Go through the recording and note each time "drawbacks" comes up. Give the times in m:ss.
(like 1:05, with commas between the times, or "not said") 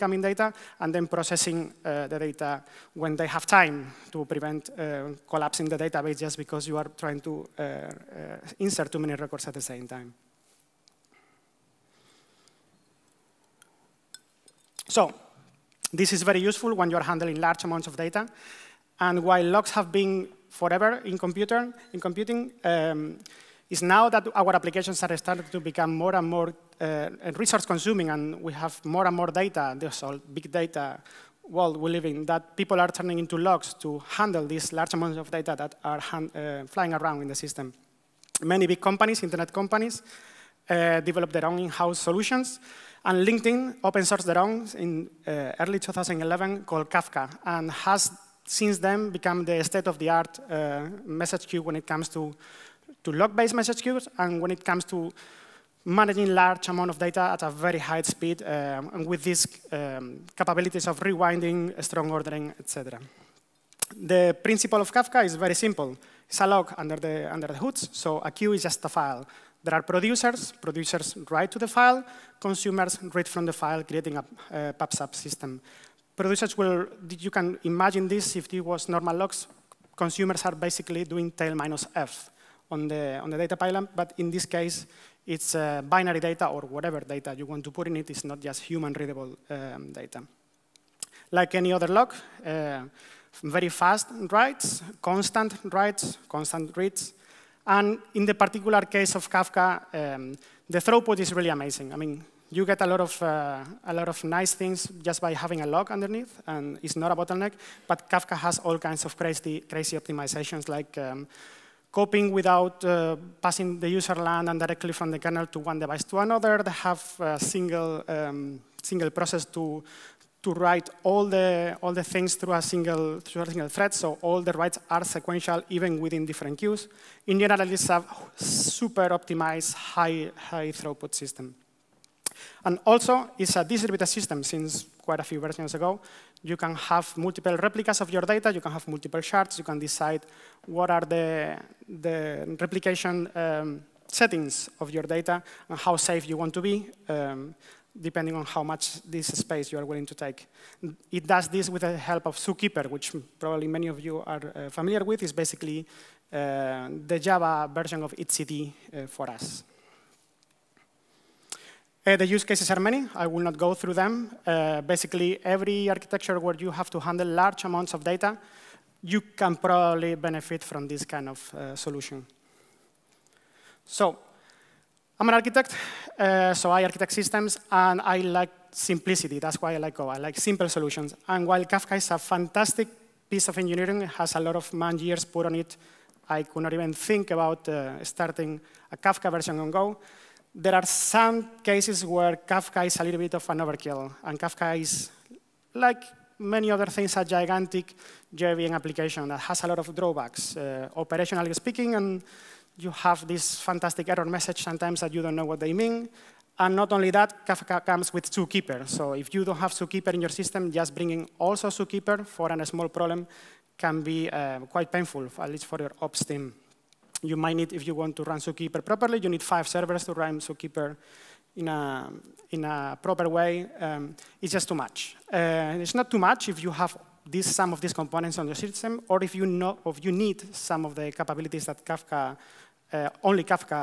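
3:19.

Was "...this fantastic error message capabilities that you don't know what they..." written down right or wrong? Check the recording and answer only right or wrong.
wrong.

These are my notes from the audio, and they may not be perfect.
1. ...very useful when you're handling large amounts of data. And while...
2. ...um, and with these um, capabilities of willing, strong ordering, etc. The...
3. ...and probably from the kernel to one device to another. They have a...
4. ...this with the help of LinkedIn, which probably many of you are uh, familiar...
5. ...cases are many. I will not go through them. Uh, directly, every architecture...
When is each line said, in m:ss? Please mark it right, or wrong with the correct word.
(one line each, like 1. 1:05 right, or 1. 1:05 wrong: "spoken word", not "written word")
1. 0:16 right
2. 0:58 wrong: "rewinding", not "willing"
3. 1:54 wrong: "directly", not "probably"
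4. 2:31 wrong: "Zookeeper", not "LinkedIn"
5. 2:42 wrong: "basically", not "directly".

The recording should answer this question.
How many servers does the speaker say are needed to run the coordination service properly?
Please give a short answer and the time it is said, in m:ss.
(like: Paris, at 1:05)
5, at 3:39.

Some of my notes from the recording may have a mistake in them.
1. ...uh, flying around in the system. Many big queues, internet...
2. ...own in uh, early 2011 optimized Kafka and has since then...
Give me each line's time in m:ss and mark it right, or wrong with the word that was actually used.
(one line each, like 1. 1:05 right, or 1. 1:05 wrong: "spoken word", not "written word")
1. 0:35 wrong: "companies", not "queues"
2. 0:44 wrong: "called", not "optimized".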